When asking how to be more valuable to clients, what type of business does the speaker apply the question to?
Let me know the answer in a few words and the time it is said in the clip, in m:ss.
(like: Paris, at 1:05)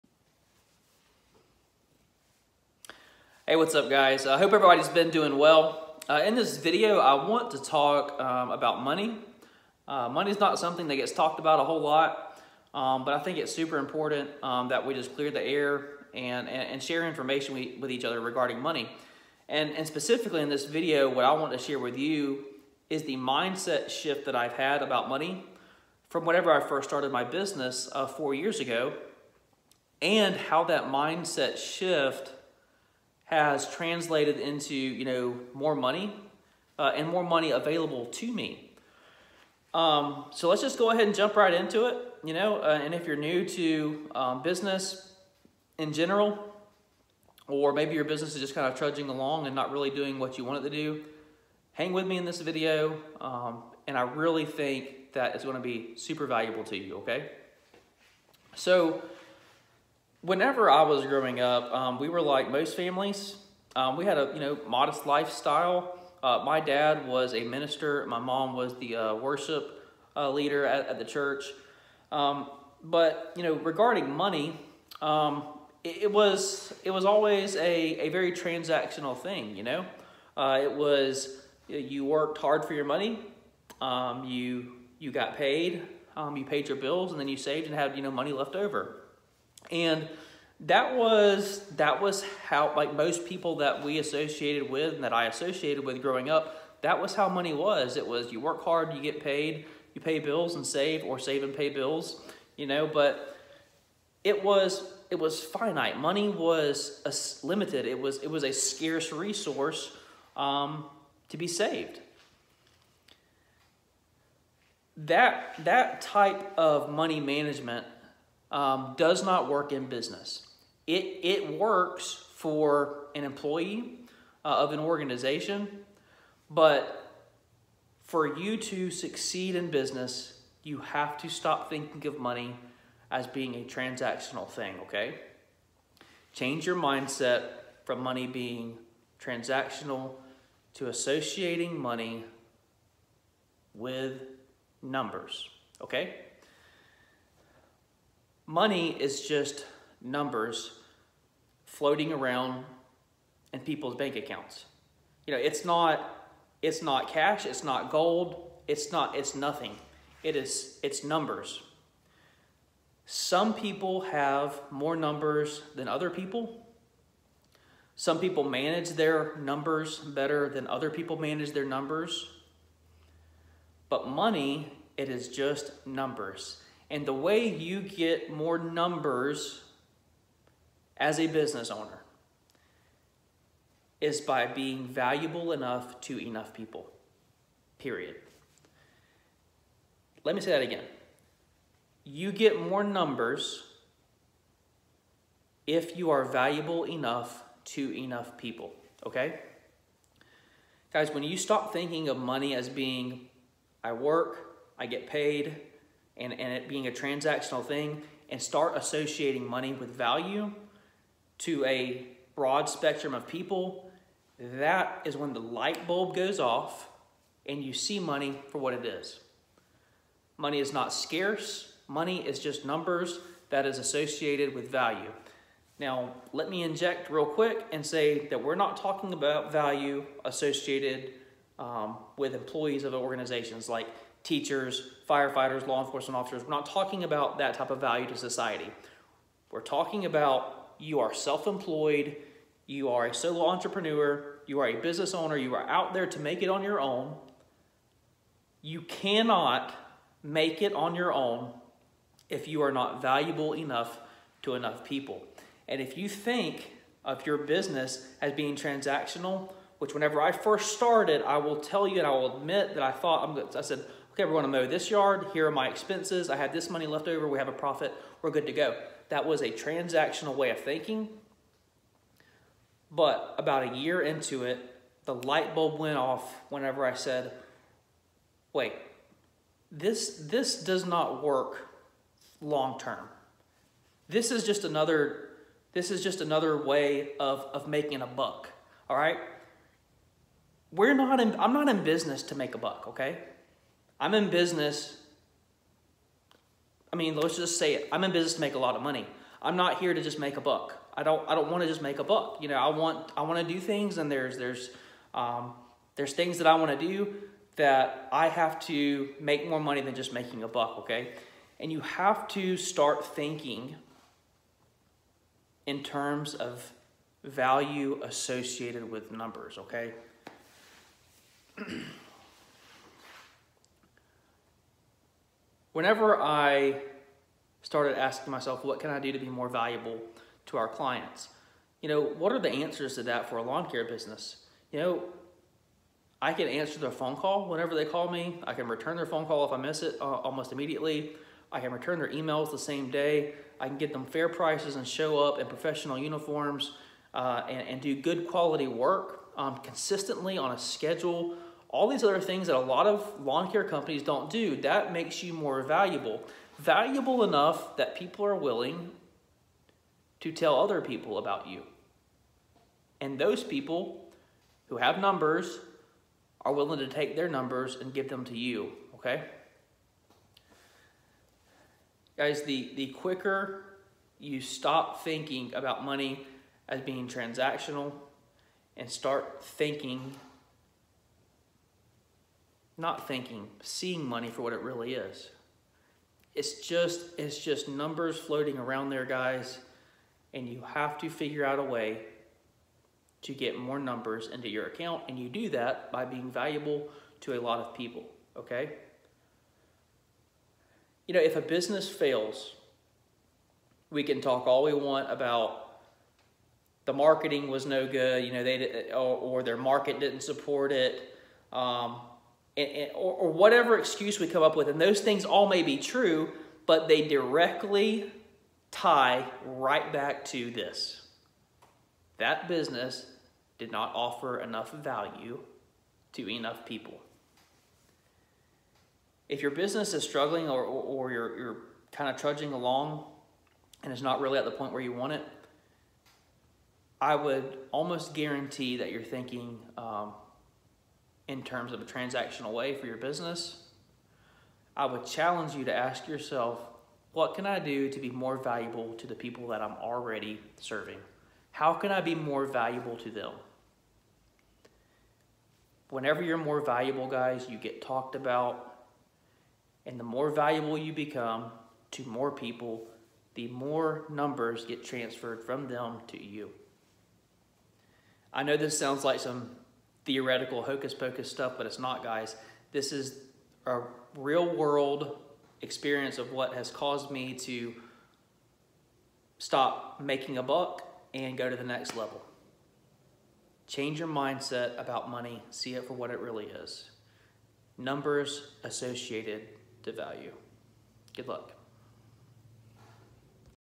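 Lawn care business, at 5:33.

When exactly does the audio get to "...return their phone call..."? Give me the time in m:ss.
5:38.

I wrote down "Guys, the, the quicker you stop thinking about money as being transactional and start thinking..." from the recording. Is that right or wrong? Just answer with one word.
right.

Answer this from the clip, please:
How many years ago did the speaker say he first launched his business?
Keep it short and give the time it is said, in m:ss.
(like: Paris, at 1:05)
4 years, at 0:28.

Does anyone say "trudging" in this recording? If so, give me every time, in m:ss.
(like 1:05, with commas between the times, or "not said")
0:48, 7:12.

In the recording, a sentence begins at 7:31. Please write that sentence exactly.
How can I be more valuable to them?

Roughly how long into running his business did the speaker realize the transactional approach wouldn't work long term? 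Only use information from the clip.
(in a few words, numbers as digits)
About a year.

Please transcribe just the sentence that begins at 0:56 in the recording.
Okay, so whenever I was growing up, um, we were like most families.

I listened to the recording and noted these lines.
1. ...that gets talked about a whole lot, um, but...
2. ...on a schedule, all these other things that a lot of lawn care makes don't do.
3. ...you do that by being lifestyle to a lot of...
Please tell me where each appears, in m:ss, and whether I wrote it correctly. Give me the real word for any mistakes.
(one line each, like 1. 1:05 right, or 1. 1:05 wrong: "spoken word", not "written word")
1. 0:10 right
2. 5:50 wrong: "companies", not "makes"
3. 6:35 wrong: "valuable", not "lifestyle".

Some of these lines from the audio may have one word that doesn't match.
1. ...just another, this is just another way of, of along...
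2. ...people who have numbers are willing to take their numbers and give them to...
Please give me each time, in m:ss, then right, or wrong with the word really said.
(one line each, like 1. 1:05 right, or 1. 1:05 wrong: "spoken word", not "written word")
1. 4:44 wrong: "making", not "along"
2. 6:03 right.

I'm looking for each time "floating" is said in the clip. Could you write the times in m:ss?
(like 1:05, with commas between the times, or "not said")
2:31, 6:28.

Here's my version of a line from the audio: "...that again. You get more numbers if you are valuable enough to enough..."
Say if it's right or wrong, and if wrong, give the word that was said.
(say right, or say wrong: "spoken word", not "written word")
right.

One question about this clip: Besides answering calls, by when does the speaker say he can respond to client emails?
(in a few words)
The same day.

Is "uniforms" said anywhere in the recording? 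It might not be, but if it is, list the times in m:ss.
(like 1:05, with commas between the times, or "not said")
5:45.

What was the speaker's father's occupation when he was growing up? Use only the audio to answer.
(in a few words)
Minister.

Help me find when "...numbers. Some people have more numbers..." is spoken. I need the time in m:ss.
2:41.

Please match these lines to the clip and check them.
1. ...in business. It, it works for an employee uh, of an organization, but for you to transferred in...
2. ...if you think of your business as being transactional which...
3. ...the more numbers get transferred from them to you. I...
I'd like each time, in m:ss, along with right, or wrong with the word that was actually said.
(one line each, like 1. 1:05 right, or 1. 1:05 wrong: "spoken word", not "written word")
1. 1:59 wrong: "succeed", not "transferred"
2. 4:15 right
3. 7:43 right.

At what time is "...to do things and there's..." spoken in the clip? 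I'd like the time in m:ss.
5:03.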